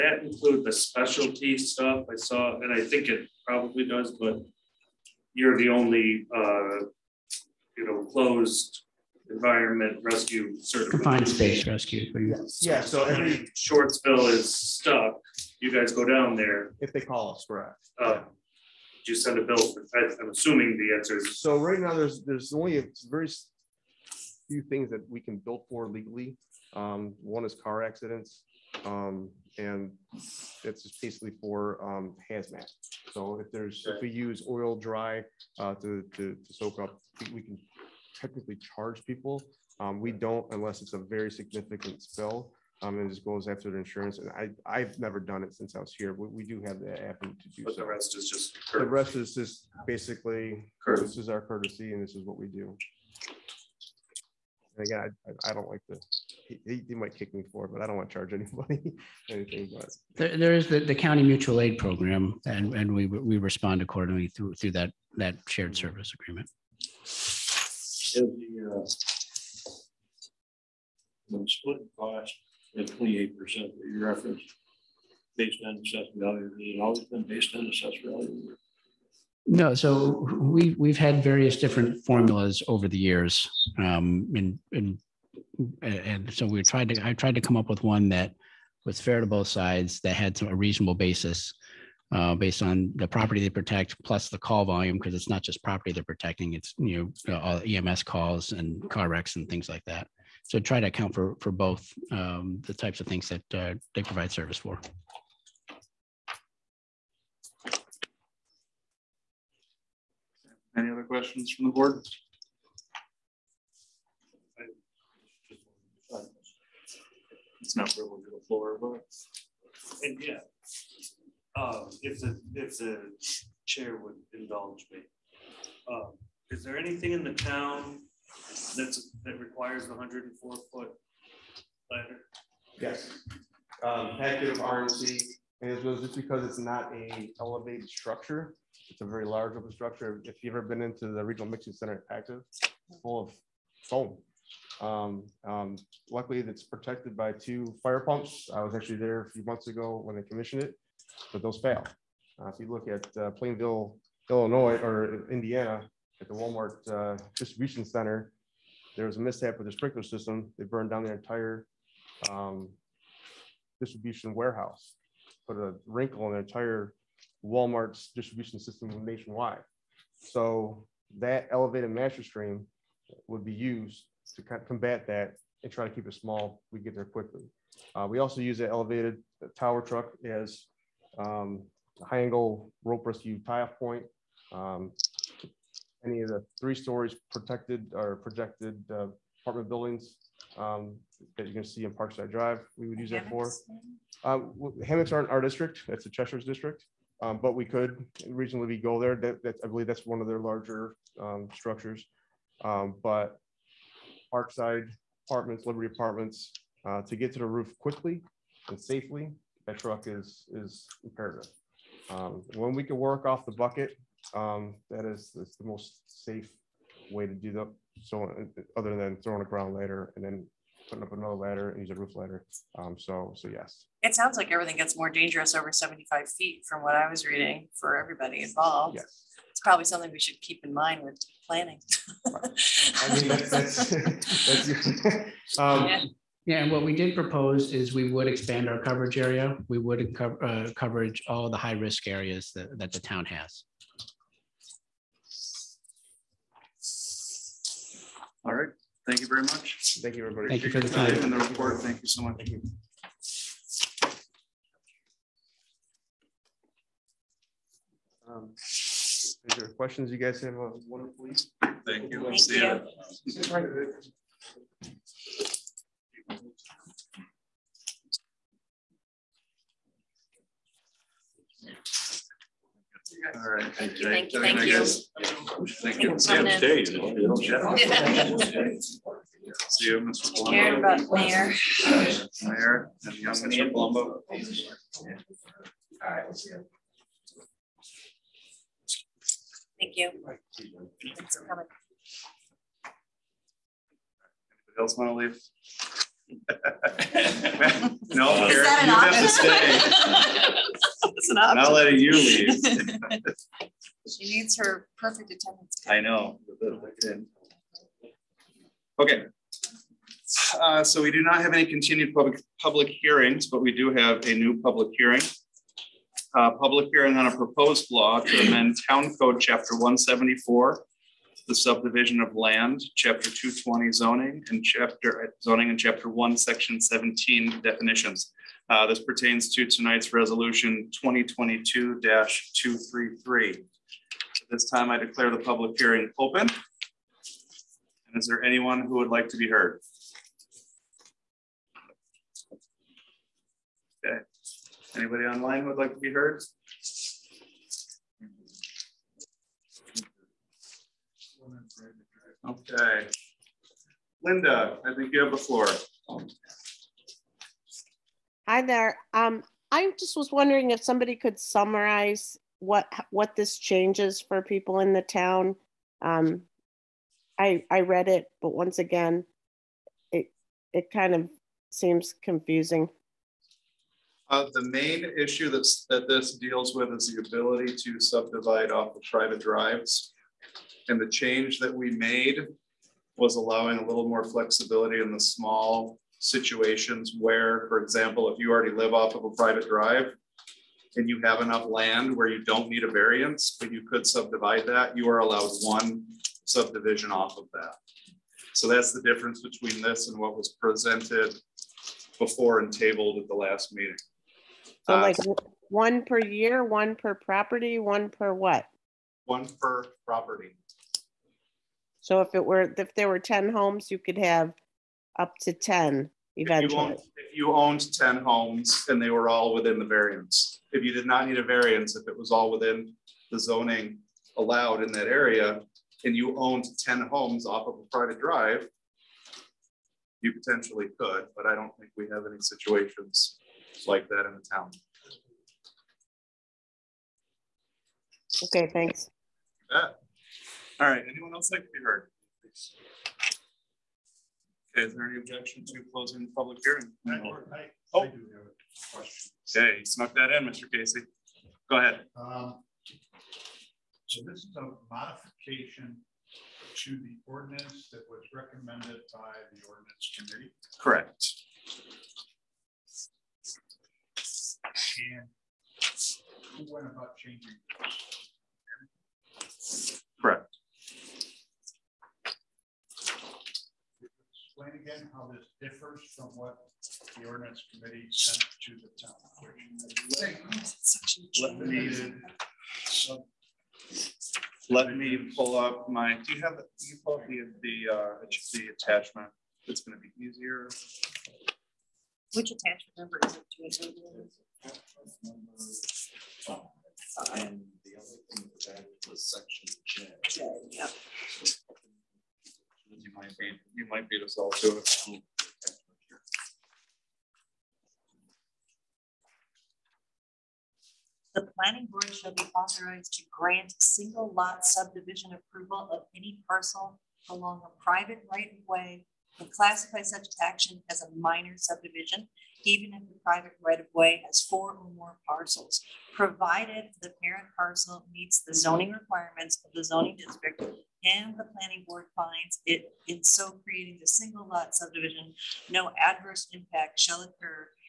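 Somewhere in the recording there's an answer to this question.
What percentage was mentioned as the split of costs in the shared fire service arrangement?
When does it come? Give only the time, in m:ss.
1:12.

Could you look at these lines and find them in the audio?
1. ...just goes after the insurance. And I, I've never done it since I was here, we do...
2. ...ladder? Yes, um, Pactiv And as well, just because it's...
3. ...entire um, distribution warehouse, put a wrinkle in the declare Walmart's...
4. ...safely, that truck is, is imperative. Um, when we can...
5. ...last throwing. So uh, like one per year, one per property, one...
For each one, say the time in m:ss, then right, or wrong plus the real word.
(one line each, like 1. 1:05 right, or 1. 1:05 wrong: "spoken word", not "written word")
1. 0:43 right
2. 2:11 right
3. 2:41 wrong: "entire", not "declare"
4. 3:28 right
5. 6:43 wrong: "meeting", not "throwing".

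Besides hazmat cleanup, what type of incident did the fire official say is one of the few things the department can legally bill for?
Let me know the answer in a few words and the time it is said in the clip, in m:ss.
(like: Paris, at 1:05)
Car accidents, at 0:27.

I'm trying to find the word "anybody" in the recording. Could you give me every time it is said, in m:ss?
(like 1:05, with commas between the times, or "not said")
0:58, 4:54, 5:44.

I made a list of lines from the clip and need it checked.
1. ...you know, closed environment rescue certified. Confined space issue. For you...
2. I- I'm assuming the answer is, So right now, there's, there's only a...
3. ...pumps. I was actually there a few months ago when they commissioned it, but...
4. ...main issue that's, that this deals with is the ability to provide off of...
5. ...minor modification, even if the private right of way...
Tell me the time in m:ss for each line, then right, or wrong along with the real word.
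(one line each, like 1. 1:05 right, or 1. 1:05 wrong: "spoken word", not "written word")
1. 0:07 wrong: "rescue", not "issue"
2. 0:19 right
3. 2:28 right
4. 6:14 wrong: "subdivide", not "provide"
5. 8:41 wrong: "subdivision", not "modification".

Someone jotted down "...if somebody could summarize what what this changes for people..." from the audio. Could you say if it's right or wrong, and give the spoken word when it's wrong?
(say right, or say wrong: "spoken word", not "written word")
right.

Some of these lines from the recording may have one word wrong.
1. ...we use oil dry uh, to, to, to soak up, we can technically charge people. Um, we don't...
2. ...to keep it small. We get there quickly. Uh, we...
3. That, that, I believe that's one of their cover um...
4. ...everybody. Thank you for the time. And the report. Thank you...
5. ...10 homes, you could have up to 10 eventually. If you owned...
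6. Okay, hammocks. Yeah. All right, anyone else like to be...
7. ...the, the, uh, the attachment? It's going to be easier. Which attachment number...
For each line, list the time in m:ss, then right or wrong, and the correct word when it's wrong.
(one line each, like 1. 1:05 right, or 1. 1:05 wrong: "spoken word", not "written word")
1. 0:34 right
2. 2:55 right
3. 3:19 wrong: "larger", not "cover"
4. 4:10 right
5. 6:53 right
6. 7:18 wrong: "thanks", not "hammocks"
7. 8:07 right.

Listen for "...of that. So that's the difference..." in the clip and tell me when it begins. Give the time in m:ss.
6:37.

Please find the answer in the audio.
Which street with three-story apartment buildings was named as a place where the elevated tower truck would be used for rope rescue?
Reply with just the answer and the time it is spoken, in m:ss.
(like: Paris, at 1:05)
Parkside Drive, at 3:11.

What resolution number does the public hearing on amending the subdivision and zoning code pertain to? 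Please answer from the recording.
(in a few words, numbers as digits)
2022-233.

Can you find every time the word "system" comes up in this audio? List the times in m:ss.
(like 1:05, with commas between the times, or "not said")
2:40, 2:48.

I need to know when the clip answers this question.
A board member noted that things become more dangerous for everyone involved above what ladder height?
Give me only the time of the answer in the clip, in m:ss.
3:45.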